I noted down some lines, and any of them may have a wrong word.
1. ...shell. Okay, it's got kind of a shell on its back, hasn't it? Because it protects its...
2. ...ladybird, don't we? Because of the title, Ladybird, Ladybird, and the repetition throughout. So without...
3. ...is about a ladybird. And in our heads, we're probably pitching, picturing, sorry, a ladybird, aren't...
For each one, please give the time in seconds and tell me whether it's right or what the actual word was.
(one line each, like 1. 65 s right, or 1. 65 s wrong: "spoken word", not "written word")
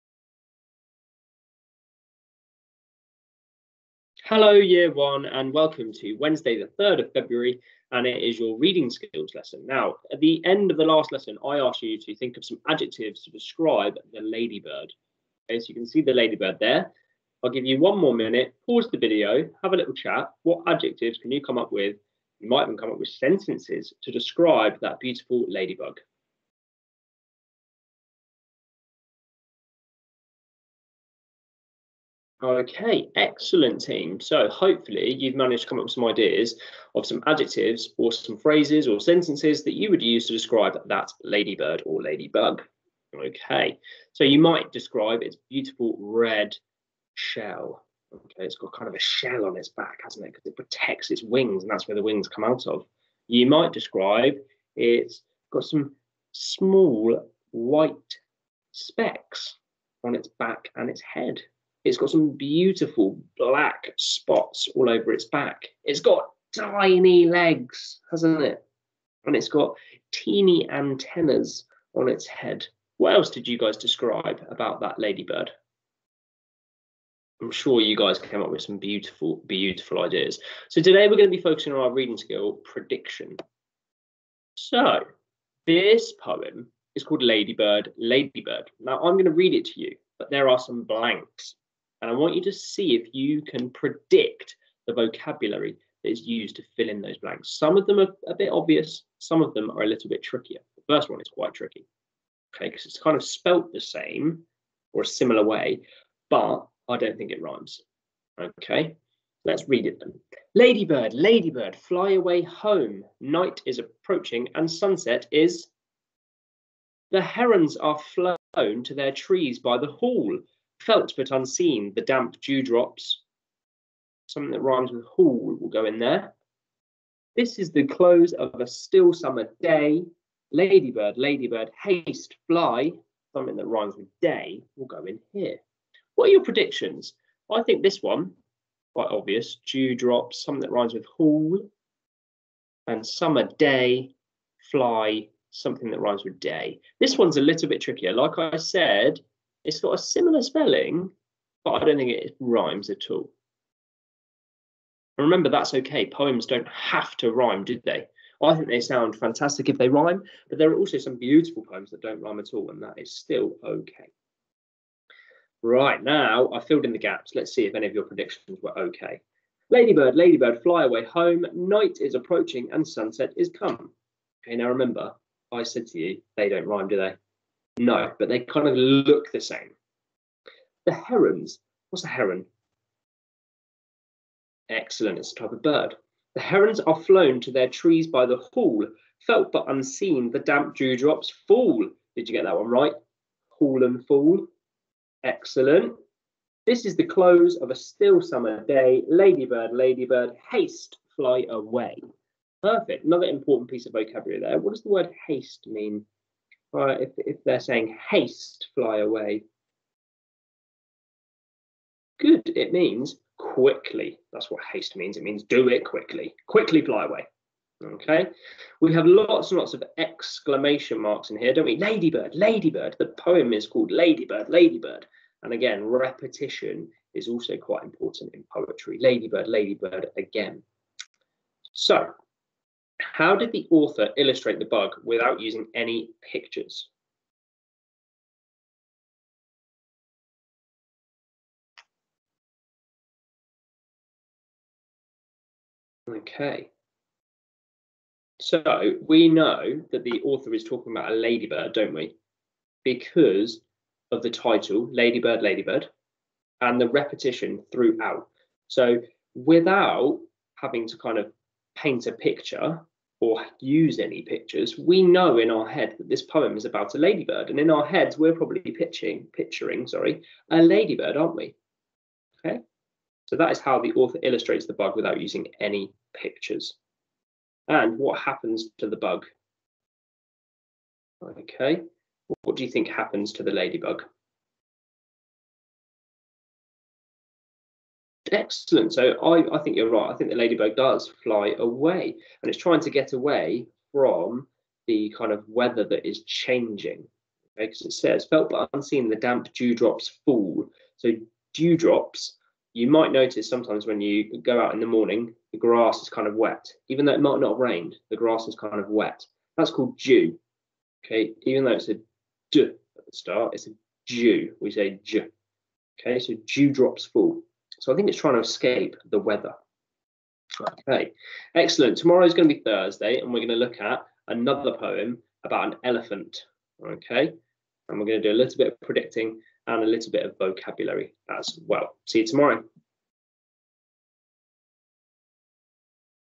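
1. 47 s right
2. 251 s right
3. 266 s right.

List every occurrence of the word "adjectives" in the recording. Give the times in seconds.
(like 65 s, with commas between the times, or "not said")
12 s, 20 s, 37 s.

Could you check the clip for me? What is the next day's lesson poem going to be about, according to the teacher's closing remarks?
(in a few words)
An elephant.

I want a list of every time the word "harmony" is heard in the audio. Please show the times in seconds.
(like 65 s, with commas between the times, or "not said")
not said.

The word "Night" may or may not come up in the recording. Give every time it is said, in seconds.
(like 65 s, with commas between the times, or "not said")
113 s, 171 s.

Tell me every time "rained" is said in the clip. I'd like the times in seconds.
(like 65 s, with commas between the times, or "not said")
307 s.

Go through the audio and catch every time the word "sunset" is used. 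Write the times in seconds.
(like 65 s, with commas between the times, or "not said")
114 s, 172 s.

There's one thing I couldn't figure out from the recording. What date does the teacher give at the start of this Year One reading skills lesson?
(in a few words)
3rd of February.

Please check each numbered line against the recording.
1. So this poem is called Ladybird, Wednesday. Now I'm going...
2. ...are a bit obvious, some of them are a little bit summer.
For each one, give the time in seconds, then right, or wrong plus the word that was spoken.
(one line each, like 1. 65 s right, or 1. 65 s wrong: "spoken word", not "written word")
1. 84 s wrong: "Ladybird", not "Wednesday"
2. 97 s wrong: "trickier", not "summer".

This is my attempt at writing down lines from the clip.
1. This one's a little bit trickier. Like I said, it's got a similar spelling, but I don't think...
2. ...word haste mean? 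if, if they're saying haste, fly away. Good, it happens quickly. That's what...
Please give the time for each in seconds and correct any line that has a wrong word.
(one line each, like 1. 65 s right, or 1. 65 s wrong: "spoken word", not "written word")
1. 146 s right
2. 204 s wrong: "means", not "happens".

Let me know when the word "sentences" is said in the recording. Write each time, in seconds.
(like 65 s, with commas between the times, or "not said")
23 s, 38 s.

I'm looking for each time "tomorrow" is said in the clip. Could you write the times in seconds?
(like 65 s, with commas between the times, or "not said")
321 s, 332 s.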